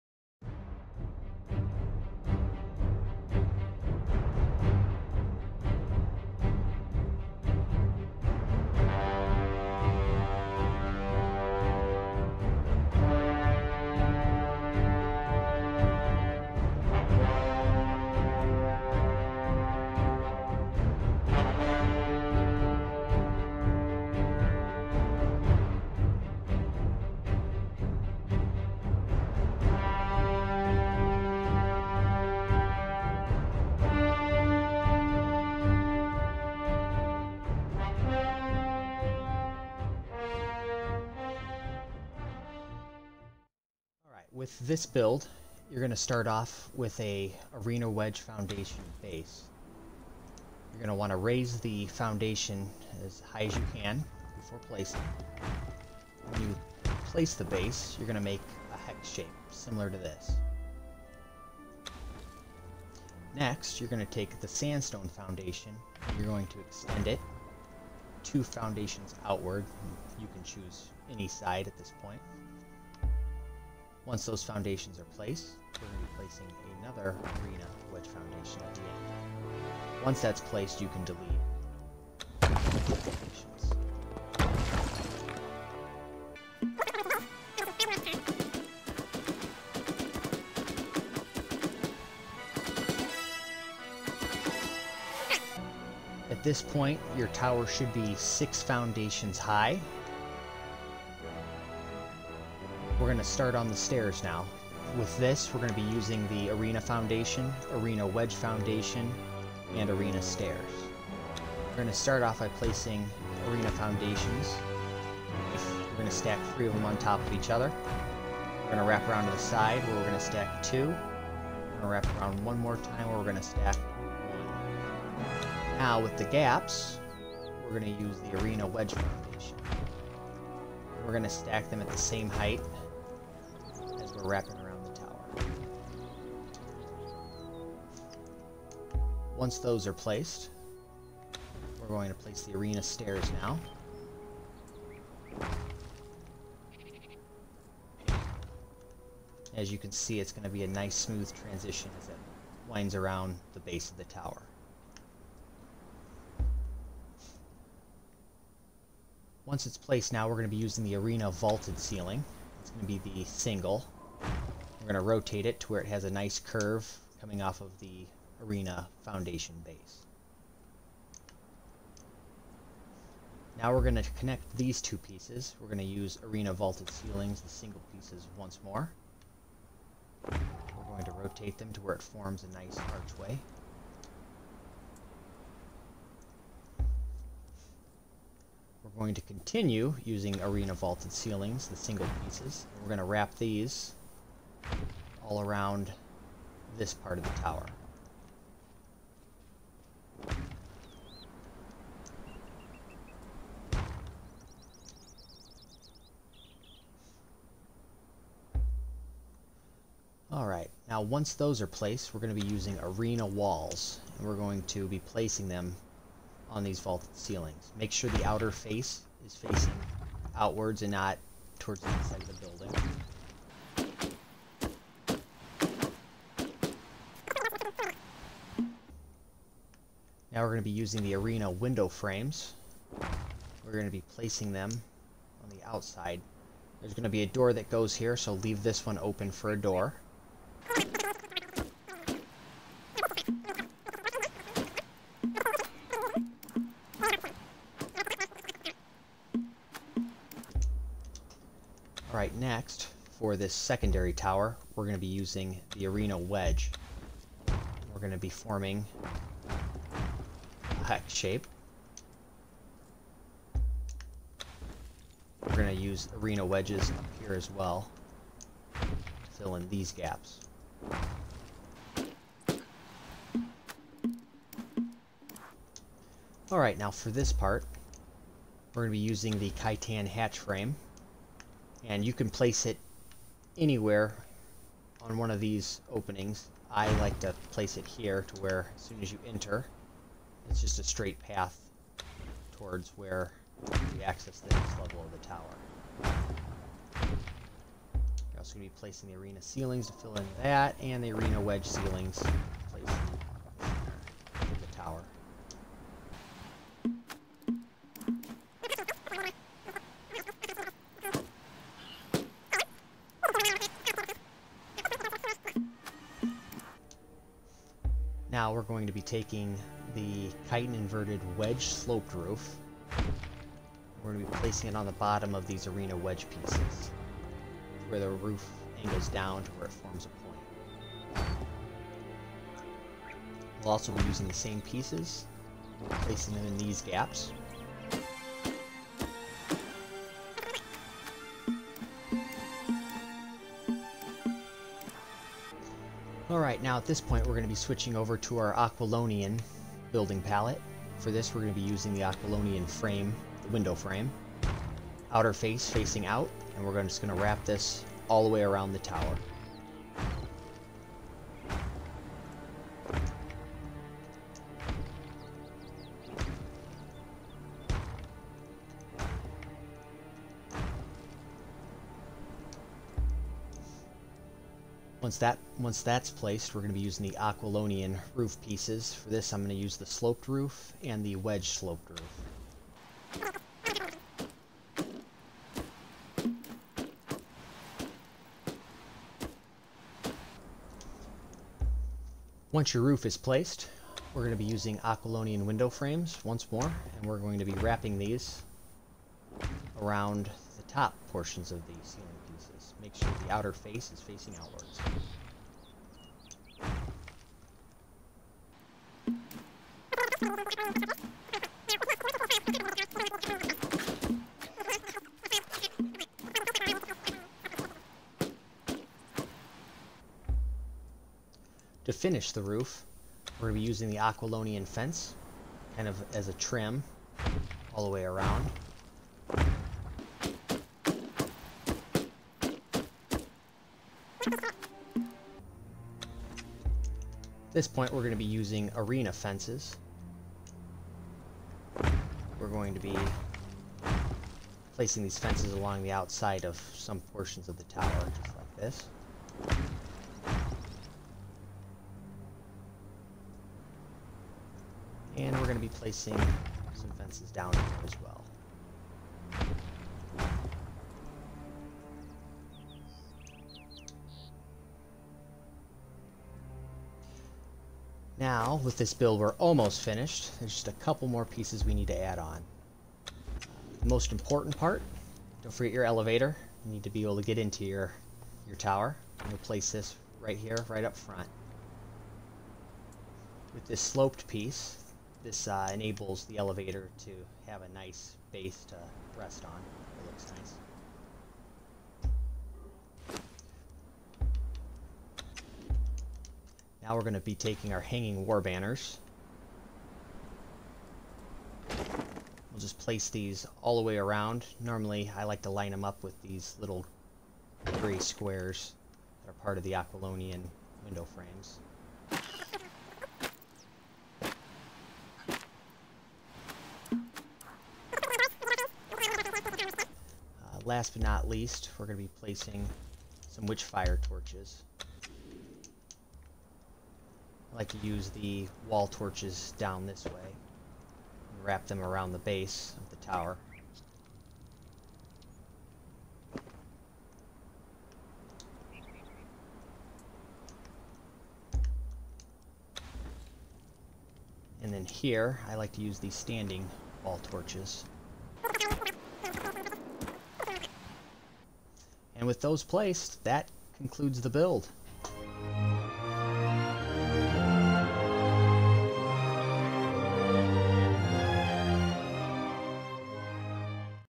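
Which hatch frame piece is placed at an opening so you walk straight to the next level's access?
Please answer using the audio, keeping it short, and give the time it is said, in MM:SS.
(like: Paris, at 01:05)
Khitan hatch frame, at 04:39.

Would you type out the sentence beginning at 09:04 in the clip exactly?
And then here, I like to use the standing wall torches.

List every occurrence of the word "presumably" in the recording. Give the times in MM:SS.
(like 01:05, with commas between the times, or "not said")
not said.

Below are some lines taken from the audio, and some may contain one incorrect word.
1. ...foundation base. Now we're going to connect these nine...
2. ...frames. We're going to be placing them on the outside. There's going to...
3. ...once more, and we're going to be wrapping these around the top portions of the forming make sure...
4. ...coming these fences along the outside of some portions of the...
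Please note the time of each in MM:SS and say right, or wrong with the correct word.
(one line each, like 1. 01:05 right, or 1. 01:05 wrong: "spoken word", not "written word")
1. 02:49 wrong: "two", not "nine"
2. 03:51 right
3. 06:36 wrong: "ceiling", not "forming"
4. 07:24 wrong: "placing", not "coming".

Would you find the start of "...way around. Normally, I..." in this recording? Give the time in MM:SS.
08:23.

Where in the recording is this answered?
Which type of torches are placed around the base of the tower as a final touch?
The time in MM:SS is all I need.
08:43.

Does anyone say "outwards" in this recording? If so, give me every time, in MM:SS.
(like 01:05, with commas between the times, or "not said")
01:09, 03:40, 06:44.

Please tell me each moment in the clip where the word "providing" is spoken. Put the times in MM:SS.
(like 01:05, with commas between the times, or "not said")
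not said.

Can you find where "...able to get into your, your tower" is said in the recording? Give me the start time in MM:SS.
07:57.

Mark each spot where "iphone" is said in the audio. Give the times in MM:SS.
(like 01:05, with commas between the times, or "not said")
not said.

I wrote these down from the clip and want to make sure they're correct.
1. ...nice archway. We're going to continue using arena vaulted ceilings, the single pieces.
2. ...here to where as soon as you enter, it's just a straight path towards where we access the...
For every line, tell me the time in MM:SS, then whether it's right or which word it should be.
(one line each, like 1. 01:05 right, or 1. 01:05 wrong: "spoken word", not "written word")
1. 03:02 right
2. 04:47 right.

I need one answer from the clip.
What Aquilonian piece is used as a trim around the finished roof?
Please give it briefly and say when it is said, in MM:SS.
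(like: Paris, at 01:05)
Aquilonian fence, at 07:03.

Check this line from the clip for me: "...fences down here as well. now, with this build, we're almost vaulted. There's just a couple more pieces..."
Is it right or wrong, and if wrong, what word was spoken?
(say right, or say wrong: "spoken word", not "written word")
wrong: "finished", not "vaulted".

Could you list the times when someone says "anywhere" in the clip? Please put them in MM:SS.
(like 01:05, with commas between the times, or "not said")
04:43.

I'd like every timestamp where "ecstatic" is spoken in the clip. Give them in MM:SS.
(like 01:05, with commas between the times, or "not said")
not said.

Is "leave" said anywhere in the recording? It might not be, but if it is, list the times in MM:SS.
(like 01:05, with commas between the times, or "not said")
03:58.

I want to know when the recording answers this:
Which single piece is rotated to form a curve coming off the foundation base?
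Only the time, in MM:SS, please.
02:40.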